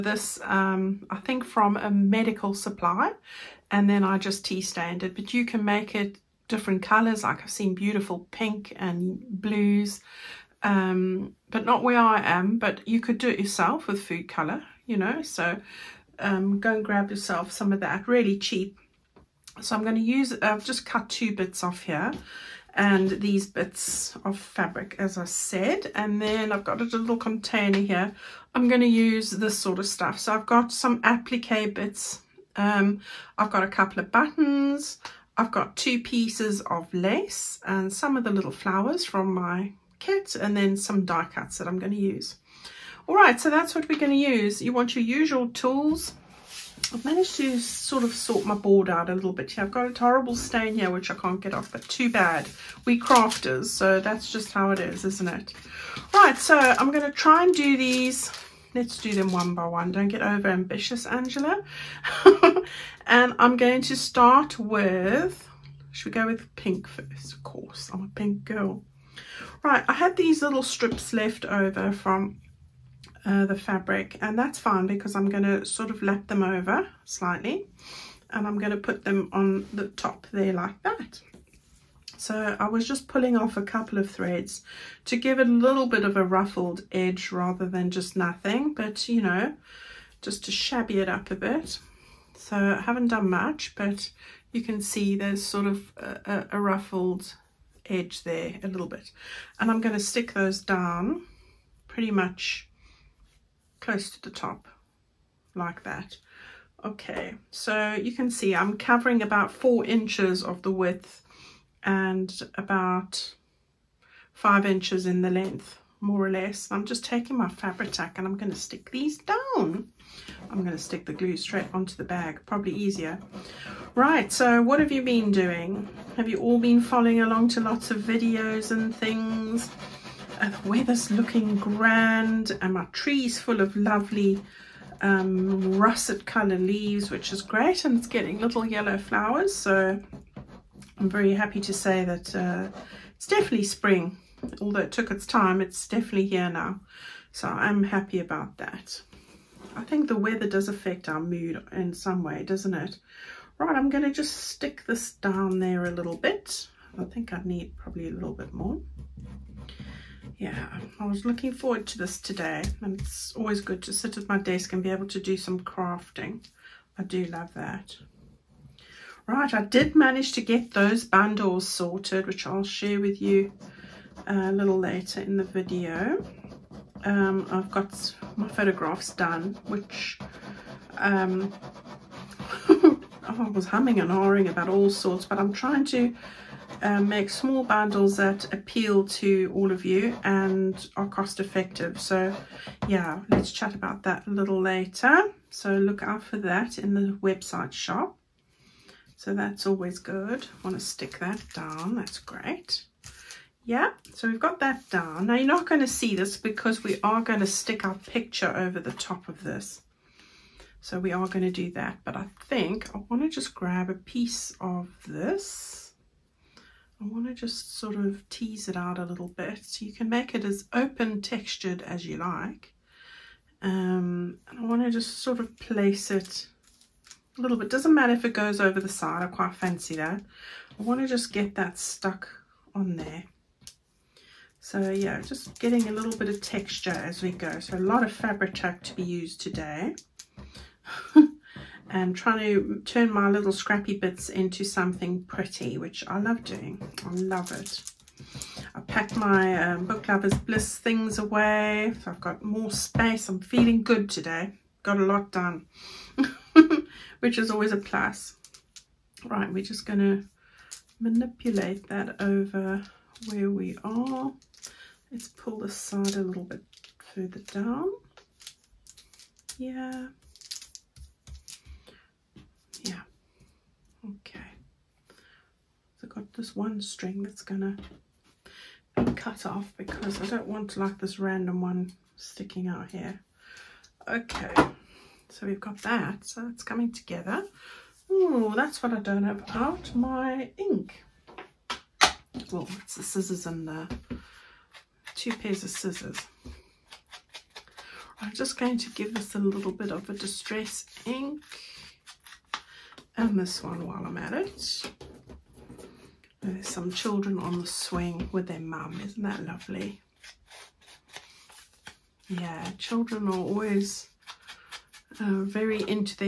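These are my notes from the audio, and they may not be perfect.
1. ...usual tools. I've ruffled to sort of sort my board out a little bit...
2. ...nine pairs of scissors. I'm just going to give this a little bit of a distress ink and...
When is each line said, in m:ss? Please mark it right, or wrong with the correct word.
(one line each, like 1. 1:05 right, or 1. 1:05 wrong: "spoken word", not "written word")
1. 0:45 wrong: "managed", not "ruffled"
2. 4:55 wrong: "two", not "nine".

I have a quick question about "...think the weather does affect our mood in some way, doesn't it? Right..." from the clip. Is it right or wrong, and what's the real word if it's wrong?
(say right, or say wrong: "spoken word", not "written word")
right.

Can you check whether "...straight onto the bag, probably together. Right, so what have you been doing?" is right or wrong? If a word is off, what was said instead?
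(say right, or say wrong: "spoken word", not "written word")
wrong: "easier", not "together".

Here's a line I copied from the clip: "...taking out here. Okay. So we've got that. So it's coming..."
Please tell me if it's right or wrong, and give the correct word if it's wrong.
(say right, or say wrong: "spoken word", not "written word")
wrong: "sticking", not "taking".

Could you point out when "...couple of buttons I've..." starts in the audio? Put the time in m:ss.
0:33.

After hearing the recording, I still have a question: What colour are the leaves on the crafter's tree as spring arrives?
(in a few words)
russet.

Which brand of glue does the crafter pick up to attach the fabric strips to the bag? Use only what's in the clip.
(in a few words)
Fabri-Tac.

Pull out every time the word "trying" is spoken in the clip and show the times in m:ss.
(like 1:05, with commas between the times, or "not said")
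3:05, 4:02.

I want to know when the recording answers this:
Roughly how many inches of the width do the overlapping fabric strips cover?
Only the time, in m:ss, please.
1:49.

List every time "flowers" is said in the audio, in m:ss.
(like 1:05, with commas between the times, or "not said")
0:38, 2:18.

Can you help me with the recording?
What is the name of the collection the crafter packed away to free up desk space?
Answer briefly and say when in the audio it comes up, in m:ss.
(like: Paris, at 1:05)
Book Lovers Bliss, at 4:09.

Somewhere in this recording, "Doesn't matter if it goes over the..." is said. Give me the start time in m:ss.
3:47.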